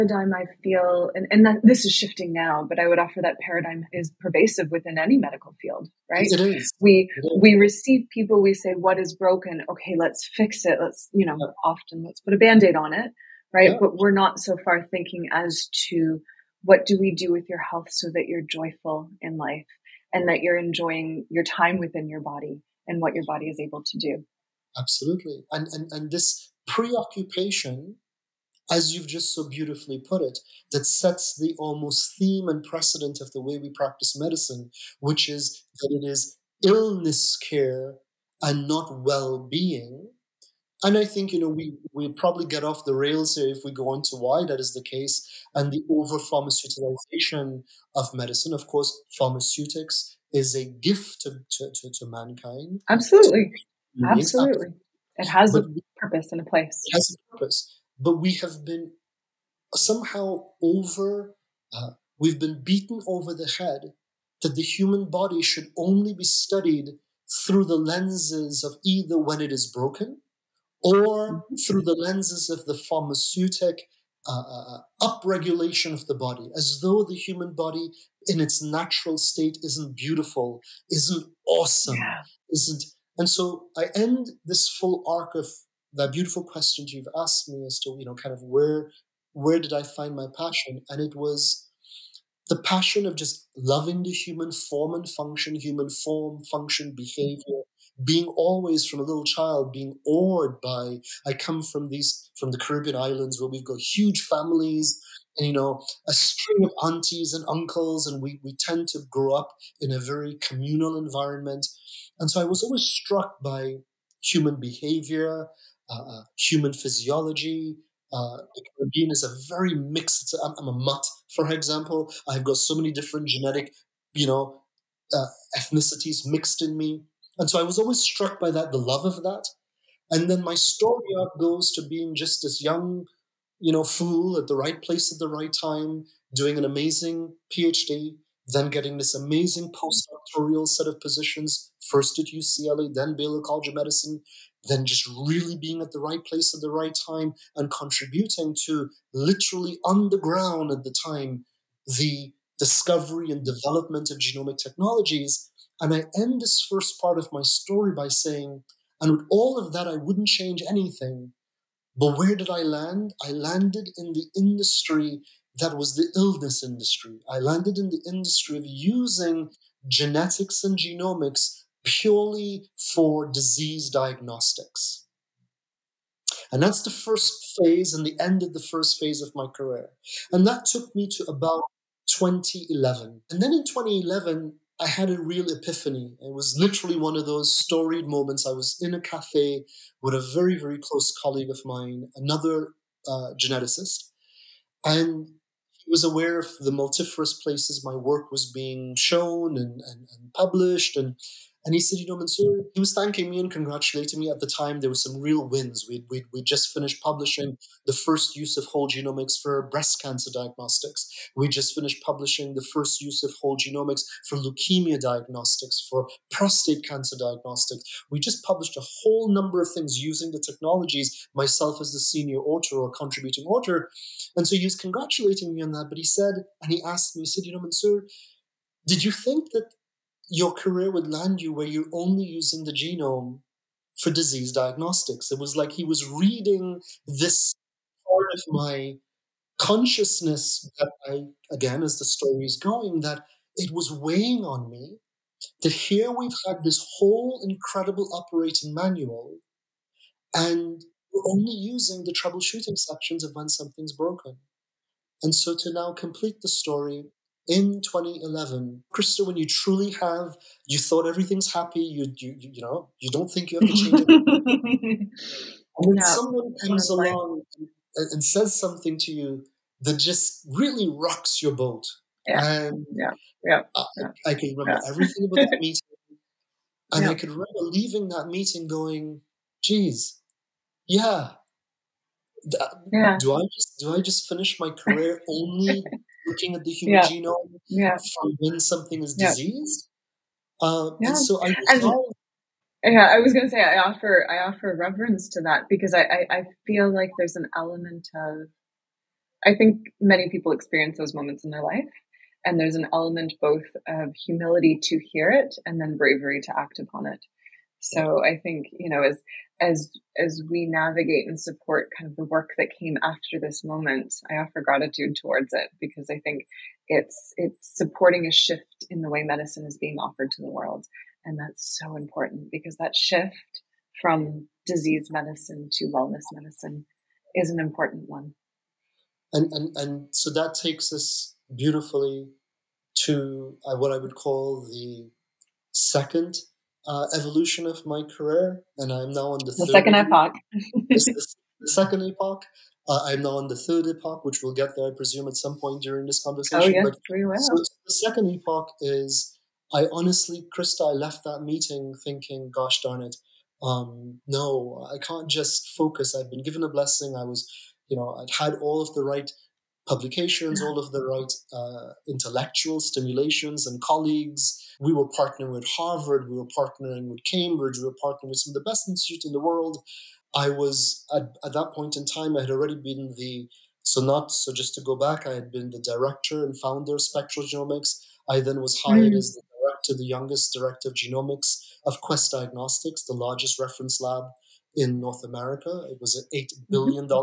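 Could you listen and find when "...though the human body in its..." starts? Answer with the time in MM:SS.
01:16.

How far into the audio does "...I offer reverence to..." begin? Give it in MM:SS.
04:54.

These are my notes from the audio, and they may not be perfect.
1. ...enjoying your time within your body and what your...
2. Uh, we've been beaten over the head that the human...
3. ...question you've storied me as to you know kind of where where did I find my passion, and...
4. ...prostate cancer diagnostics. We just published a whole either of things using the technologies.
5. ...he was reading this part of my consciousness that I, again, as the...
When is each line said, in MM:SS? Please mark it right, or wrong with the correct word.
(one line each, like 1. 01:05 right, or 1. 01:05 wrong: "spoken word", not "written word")
1. 00:20 right
2. 01:01 right
3. 01:26 wrong: "asked", not "storied"
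4. 03:36 wrong: "number", not "either"
5. 03:55 right.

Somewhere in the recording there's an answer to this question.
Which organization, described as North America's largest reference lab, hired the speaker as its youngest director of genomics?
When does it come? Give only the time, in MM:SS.
06:21.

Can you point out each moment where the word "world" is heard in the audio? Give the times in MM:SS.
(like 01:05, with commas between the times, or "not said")
05:20, 06:09.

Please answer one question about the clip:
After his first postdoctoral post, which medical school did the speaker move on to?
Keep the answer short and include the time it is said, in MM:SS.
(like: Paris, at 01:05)
Baylor College of Medicine, at 02:23.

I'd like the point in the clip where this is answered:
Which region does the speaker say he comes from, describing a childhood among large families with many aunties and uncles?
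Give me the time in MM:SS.
01:42.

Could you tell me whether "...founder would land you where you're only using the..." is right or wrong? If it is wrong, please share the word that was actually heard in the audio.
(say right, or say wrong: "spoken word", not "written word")
wrong: "career", not "founder".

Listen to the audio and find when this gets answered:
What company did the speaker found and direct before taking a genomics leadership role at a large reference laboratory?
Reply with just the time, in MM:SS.
06:17.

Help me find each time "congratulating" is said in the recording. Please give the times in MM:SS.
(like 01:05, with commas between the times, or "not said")
03:23, 03:44.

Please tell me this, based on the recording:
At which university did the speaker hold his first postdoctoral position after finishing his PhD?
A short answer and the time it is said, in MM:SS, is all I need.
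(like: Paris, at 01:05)
UCLA, at 02:22.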